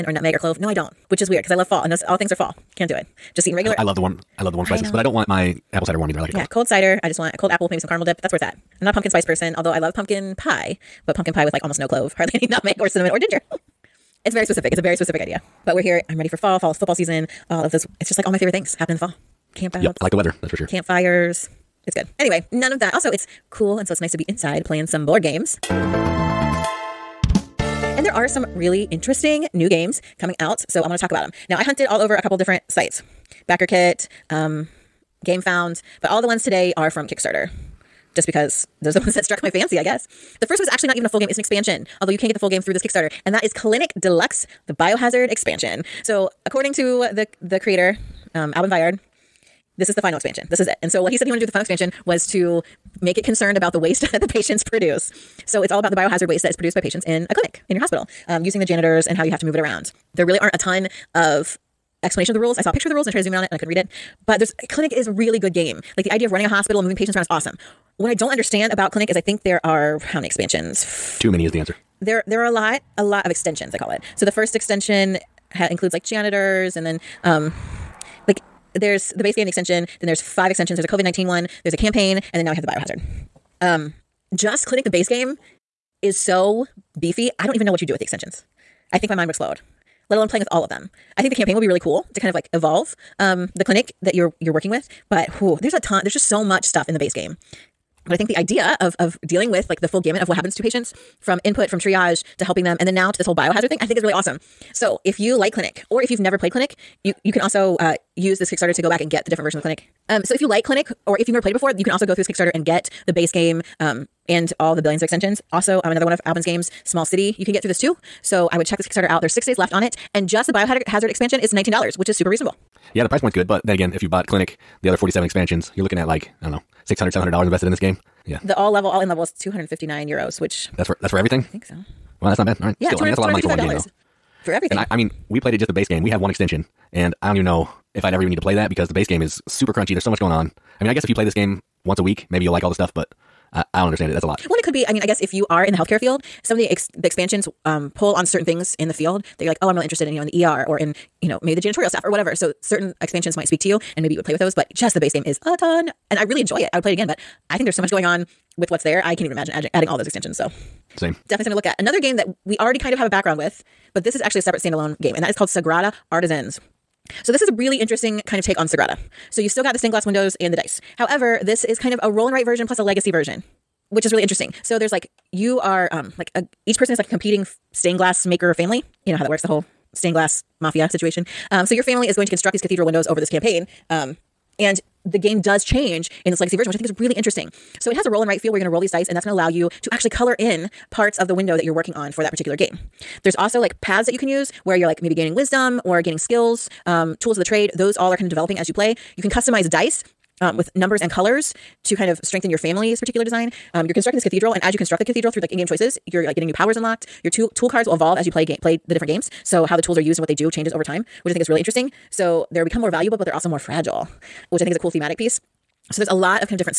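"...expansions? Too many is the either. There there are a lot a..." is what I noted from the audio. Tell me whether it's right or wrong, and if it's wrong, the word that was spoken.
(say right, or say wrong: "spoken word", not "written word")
wrong: "answer", not "either".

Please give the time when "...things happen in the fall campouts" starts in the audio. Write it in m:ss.
0:18.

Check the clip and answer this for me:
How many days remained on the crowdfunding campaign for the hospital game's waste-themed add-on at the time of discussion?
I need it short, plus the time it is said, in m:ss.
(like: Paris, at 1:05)
6, at 1:59.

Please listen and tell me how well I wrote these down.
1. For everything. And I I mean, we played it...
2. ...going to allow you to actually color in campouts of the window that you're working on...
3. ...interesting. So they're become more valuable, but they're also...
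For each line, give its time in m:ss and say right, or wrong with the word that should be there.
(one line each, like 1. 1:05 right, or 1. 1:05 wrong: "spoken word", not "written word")
1. 2:14 right
2. 3:09 wrong: "parts", not "campouts"
3. 3:31 right.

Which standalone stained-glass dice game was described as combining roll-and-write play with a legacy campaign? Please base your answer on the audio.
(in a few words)
Sagrada Artisans.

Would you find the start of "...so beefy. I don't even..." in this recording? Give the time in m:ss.
1:26.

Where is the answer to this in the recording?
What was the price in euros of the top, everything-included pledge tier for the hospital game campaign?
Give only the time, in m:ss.
2:09.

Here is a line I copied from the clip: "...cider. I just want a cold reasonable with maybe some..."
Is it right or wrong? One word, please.
wrong.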